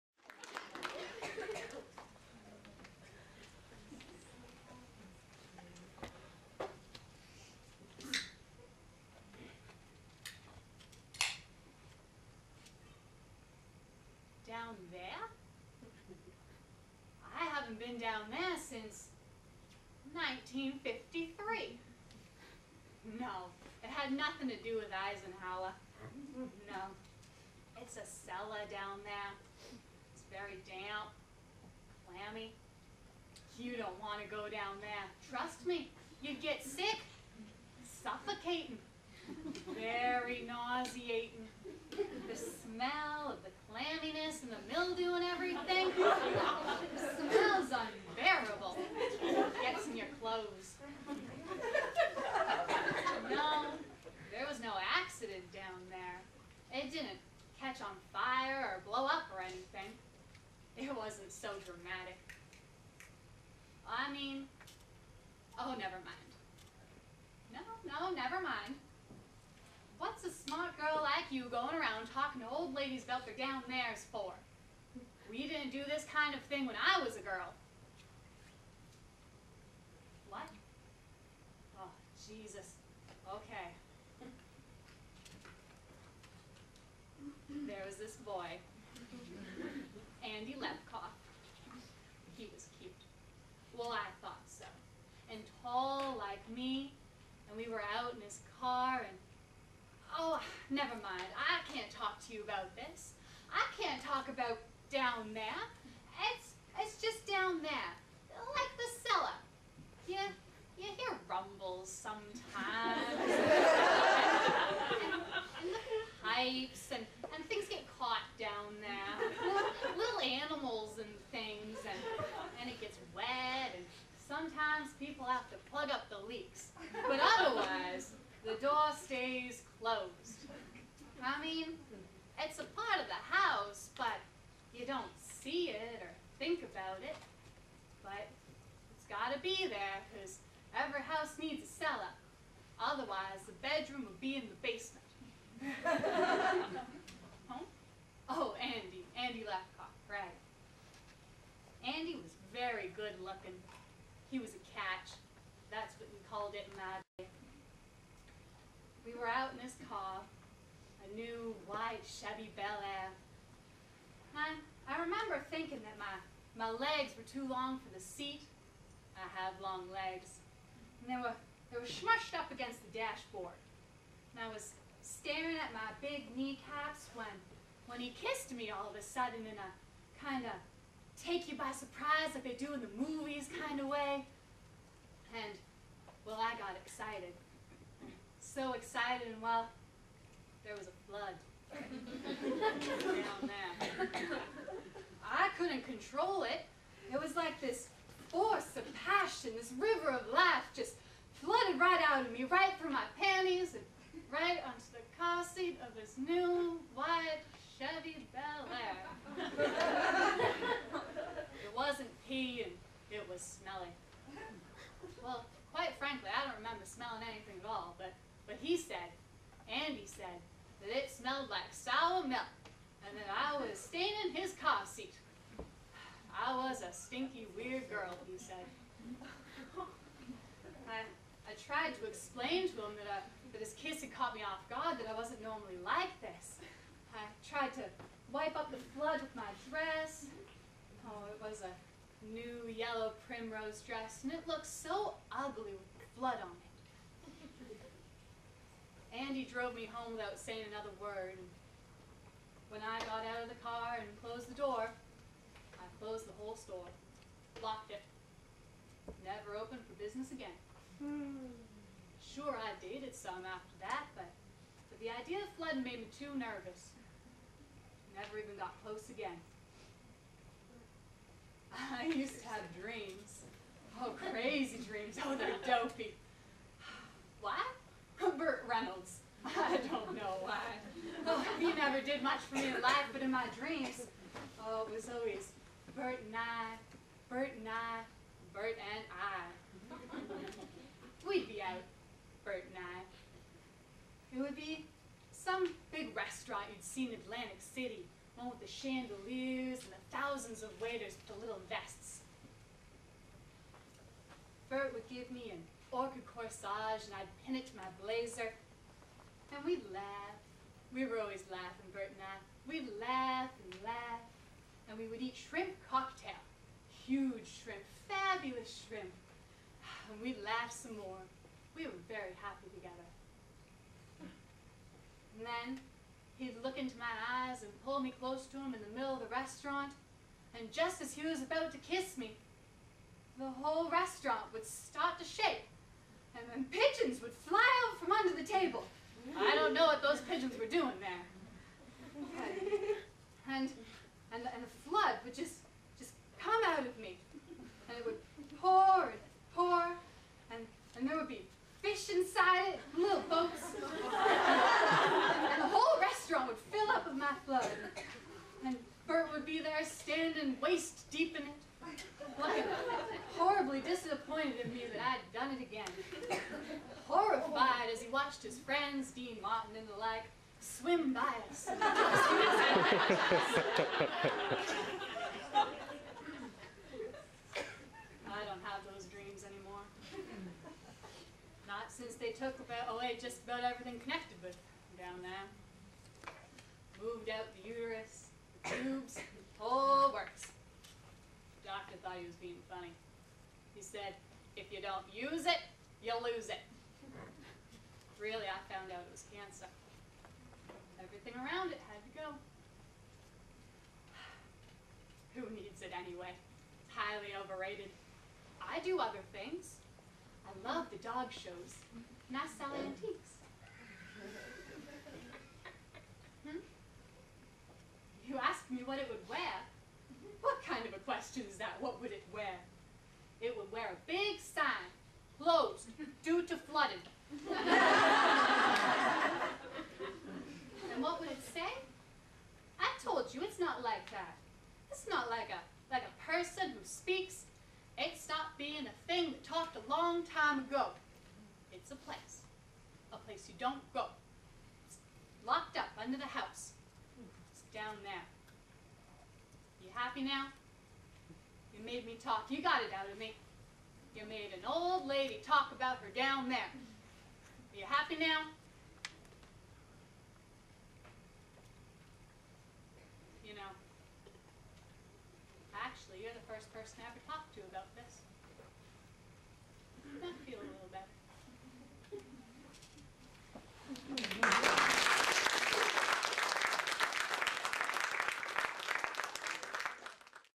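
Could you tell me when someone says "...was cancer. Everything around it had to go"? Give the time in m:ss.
6:39.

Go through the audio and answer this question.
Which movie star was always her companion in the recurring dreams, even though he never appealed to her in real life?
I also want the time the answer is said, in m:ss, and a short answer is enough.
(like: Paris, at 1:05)
Burt Reynolds, at 4:38.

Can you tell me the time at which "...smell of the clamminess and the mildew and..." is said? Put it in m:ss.
0:42.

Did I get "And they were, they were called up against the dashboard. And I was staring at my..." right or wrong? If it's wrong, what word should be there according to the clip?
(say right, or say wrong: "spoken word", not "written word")
wrong: "smushed", not "called".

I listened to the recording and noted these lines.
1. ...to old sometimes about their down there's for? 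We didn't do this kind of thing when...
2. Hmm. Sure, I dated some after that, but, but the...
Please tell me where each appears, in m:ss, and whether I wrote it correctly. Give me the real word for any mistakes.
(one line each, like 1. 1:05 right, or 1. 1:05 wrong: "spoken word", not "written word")
1. 1:12 wrong: "ladies", not "sometimes"
2. 4:20 right.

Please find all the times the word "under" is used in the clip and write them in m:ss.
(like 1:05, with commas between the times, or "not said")
5:38, 7:26.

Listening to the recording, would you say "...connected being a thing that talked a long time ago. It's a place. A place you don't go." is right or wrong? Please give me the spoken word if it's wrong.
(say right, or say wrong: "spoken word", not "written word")
wrong: "stopped", not "connected".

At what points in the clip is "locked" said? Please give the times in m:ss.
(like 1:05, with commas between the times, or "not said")
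4:17, 7:25.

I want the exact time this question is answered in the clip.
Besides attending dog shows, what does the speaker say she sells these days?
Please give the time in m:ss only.
6:52.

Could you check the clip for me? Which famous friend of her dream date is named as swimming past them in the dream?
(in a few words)
Dean Martin.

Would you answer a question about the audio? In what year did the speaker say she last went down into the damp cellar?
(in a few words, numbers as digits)
1953.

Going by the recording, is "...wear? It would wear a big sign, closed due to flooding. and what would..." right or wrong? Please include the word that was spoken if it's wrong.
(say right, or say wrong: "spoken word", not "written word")
right.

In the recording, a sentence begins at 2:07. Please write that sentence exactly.
But otherwise, the door stays closed.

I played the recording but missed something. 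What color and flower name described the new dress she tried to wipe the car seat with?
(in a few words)
yellow primrose.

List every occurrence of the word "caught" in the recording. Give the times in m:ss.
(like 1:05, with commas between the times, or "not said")
1:57, 3:54.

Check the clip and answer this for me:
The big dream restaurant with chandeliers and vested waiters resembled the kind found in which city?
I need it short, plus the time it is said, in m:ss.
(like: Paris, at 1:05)
Atlantic City, at 4:57.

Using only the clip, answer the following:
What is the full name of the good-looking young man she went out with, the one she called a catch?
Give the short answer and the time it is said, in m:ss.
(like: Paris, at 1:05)
Andy Lapcock, at 2:29.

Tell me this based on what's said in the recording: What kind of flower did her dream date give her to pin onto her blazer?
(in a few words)
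orchid.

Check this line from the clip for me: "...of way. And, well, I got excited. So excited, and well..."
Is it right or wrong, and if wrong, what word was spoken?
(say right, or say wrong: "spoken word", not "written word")
right.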